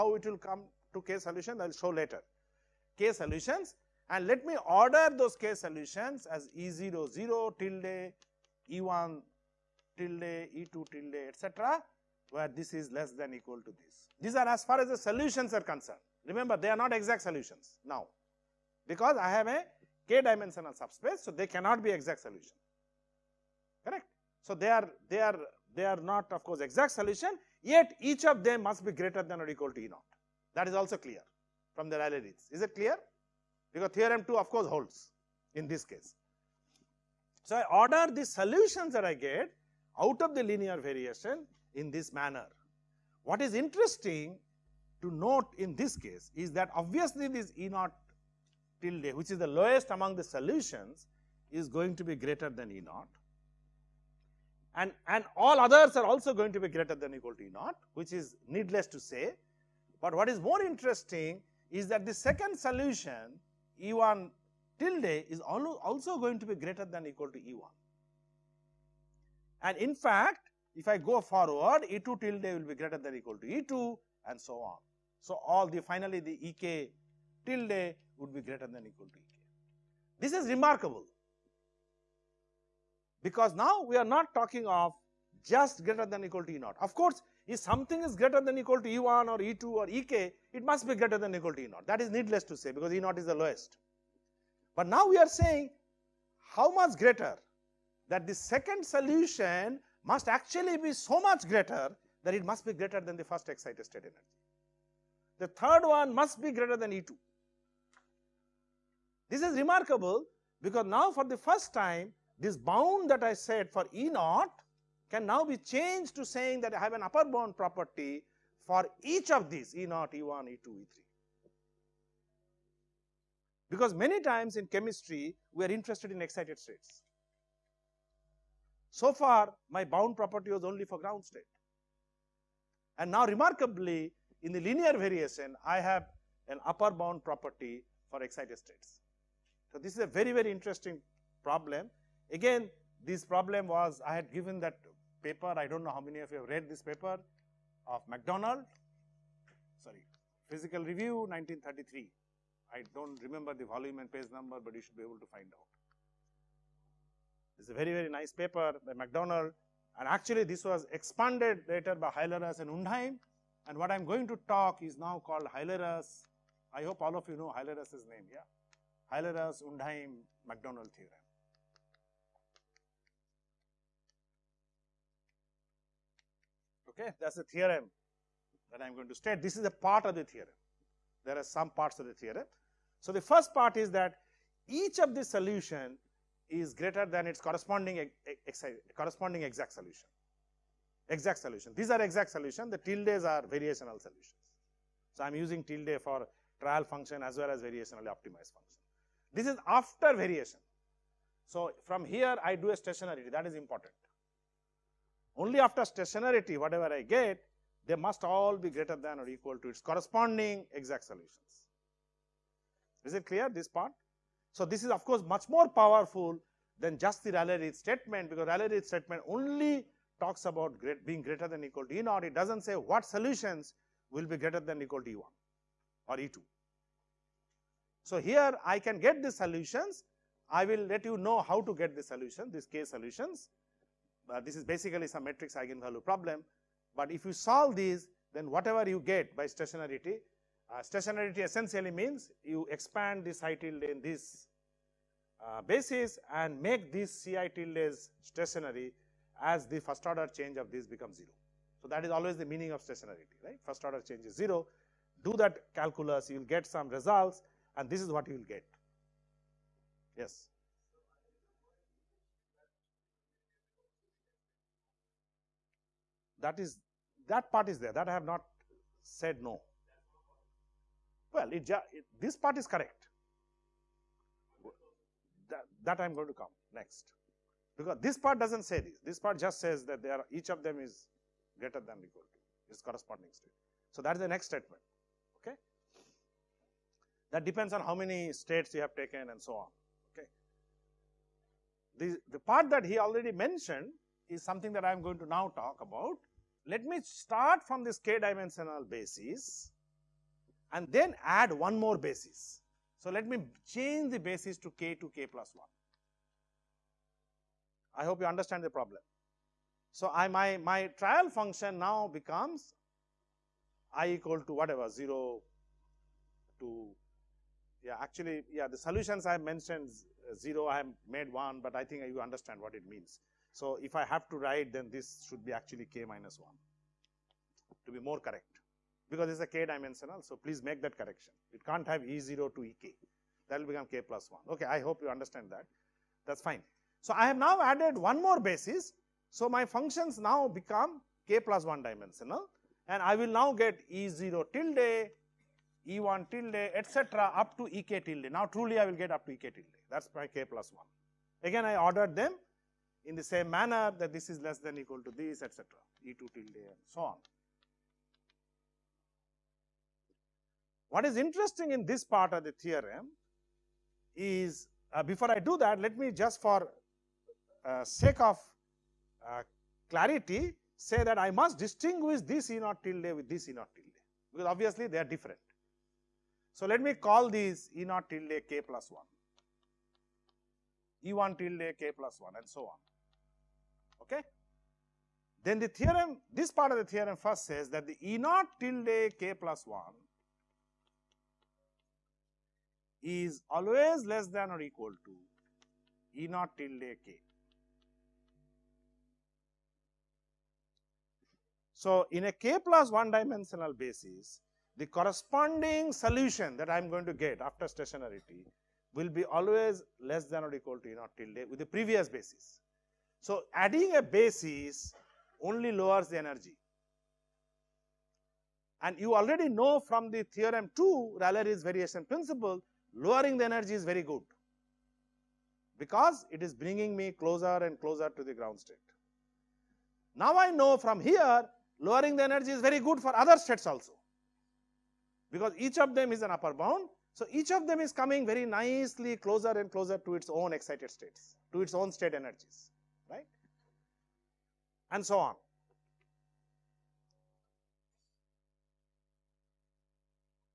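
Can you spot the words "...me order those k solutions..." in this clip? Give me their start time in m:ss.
0:04.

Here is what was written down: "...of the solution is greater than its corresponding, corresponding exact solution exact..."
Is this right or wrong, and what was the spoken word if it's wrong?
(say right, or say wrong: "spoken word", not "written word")
right.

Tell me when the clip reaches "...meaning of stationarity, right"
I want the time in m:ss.
4:12.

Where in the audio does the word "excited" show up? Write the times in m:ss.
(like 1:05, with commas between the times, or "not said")
1:43, 2:06, 2:18, 7:20.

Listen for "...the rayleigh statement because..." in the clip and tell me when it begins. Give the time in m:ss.
3:37.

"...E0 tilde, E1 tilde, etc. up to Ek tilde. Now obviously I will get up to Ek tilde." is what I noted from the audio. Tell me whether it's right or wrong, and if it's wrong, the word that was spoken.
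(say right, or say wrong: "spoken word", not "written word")
wrong: "truly", not "obviously".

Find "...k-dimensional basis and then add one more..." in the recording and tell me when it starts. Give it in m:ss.
4:57.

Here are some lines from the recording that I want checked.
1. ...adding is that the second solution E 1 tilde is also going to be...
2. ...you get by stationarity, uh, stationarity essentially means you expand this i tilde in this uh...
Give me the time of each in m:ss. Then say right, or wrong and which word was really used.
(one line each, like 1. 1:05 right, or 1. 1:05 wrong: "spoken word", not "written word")
1. 1:00 wrong: "interesting", not "adding"
2. 3:58 right.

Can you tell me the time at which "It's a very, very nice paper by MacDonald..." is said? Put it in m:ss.
2:37.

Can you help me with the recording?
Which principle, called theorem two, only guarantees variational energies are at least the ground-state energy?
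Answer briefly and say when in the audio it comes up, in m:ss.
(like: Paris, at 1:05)
Rayleigh's variation principle, at 7:01.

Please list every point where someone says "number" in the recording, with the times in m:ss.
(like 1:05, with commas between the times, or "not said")
2:34.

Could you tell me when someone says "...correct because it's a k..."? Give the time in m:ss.
5:28.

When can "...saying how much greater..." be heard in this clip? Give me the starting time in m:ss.
1:35.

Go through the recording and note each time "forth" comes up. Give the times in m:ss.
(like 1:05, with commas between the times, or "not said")
not said.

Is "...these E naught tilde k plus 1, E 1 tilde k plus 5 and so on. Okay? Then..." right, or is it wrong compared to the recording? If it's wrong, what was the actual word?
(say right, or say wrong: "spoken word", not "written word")
wrong: "1", not "5".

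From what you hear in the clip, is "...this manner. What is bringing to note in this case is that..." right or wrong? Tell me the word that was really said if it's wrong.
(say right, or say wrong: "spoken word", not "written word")
wrong: "interesting", not "bringing".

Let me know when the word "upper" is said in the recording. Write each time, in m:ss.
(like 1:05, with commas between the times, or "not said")
1:57, 2:16, 7:16.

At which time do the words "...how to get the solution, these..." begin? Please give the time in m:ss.
3:51.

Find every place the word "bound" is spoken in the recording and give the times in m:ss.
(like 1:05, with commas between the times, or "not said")
1:52, 1:57, 2:09, 2:16, 7:16.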